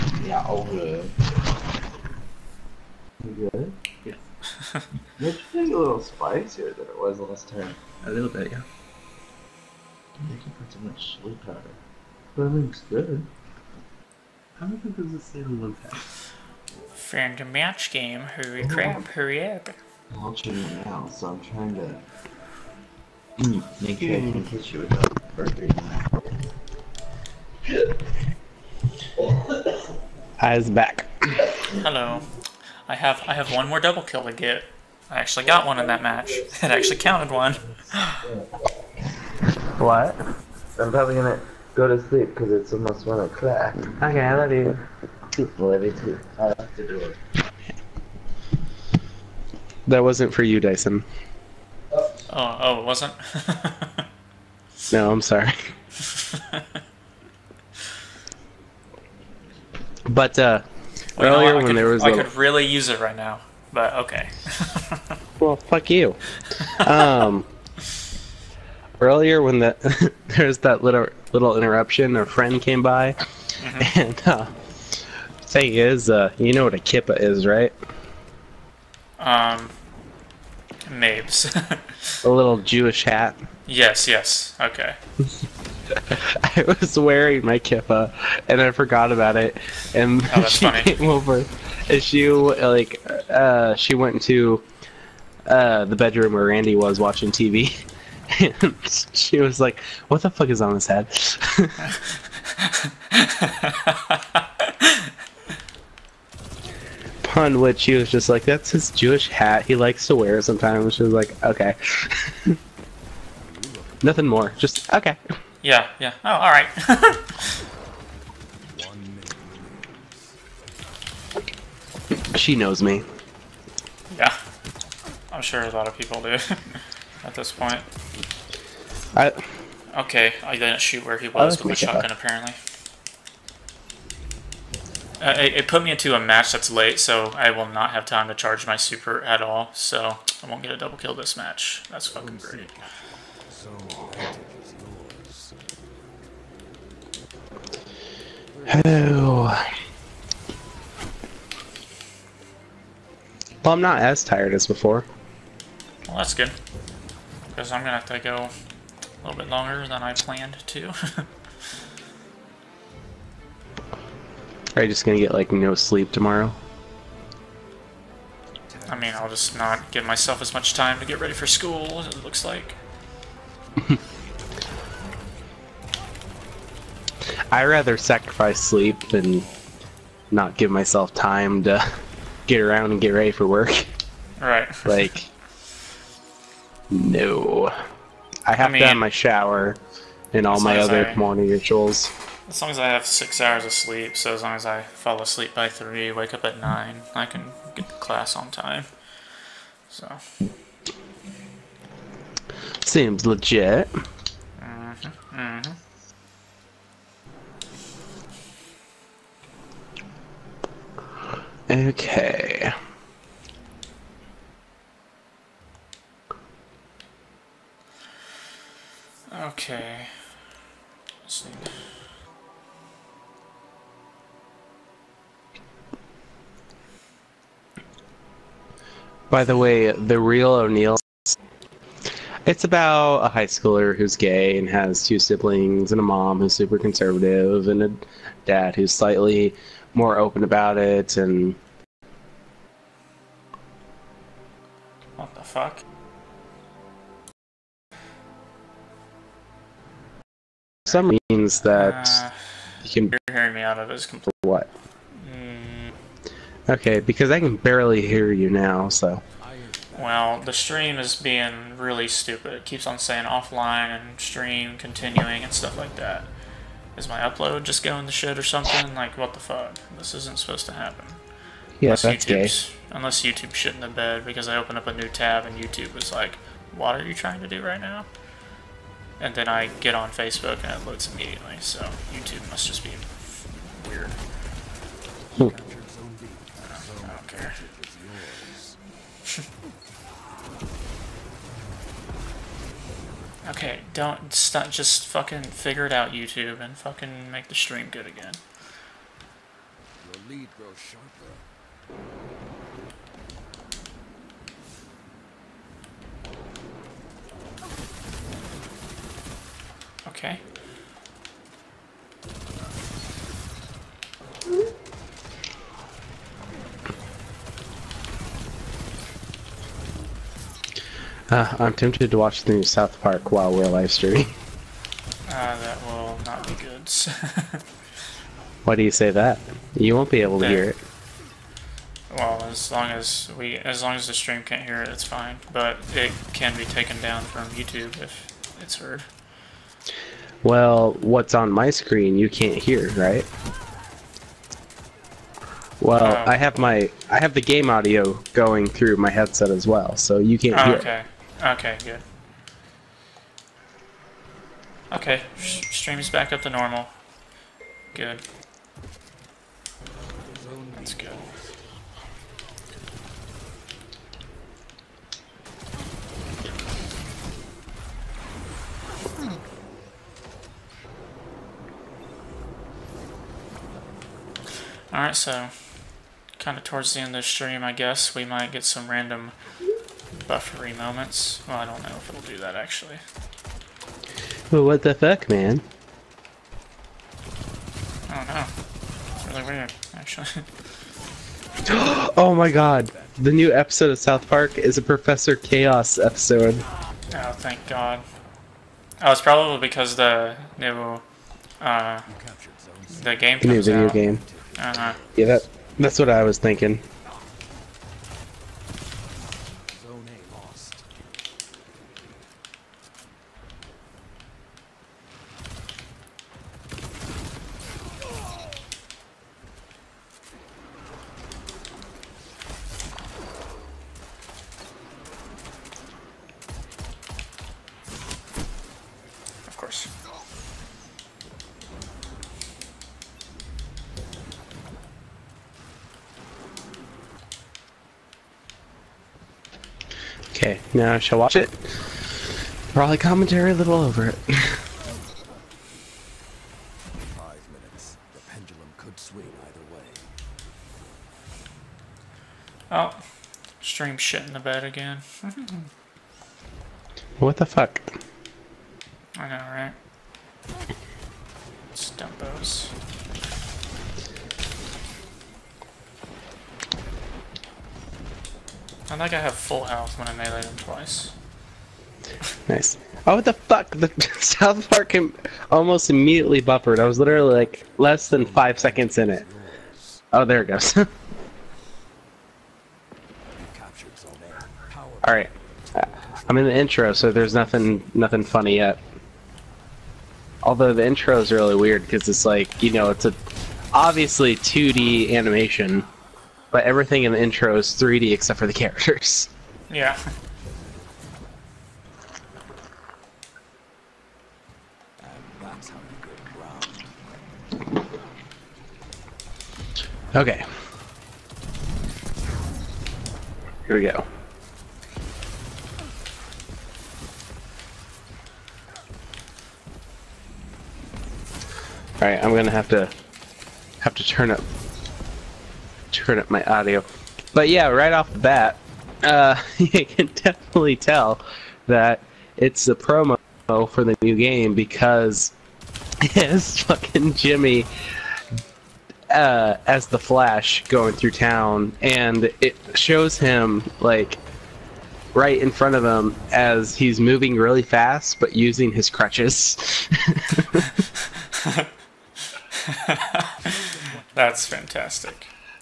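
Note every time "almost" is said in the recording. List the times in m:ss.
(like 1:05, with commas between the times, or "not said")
0:42, 7:55.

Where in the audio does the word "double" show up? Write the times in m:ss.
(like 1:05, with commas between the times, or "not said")
0:33, 2:20.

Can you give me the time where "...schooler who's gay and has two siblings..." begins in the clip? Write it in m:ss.
3:53.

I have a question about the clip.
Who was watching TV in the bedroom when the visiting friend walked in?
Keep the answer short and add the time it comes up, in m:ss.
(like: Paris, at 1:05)
Randy, at 1:36.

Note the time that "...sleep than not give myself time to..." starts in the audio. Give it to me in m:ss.
2:58.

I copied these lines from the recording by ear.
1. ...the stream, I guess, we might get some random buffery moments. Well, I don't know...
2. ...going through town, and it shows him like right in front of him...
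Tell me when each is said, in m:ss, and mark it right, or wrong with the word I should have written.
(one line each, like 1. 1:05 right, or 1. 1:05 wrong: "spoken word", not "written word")
1. 6:17 right
2. 9:00 right.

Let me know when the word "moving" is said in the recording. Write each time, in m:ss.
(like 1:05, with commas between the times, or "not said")
9:07.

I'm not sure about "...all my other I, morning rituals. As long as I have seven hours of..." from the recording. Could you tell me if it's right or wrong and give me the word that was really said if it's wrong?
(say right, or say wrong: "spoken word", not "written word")
wrong: "six", not "seven".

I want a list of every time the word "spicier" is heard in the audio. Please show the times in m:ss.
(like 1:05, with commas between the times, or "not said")
0:06.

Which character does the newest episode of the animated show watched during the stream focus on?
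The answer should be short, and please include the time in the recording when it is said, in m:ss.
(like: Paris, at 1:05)
Professor Chaos, at 6:34.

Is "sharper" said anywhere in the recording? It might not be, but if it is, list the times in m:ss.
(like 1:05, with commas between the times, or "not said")
5:00.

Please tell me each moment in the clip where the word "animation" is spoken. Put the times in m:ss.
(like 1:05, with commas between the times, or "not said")
8:15.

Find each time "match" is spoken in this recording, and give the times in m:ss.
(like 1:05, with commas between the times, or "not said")
0:17, 0:36, 2:16, 2:21.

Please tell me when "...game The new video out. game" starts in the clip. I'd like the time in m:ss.
6:43.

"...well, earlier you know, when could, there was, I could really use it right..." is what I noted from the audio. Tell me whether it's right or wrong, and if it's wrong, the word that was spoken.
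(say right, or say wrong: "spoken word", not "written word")
right.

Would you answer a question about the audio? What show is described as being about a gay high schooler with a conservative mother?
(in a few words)
The Real O'Neill.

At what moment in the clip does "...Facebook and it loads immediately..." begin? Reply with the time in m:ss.
4:40.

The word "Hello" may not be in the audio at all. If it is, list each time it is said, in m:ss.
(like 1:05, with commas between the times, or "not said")
0:31, 2:28.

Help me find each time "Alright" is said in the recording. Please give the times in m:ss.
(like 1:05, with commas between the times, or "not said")
6:14, 8:41.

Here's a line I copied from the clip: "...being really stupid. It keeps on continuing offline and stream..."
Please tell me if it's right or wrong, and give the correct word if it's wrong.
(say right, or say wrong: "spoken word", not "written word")
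wrong: "saying", not "continuing".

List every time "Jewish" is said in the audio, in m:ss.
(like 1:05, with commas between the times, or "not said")
1:22, 1:48.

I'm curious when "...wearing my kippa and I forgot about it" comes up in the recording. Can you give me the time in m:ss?
1:26.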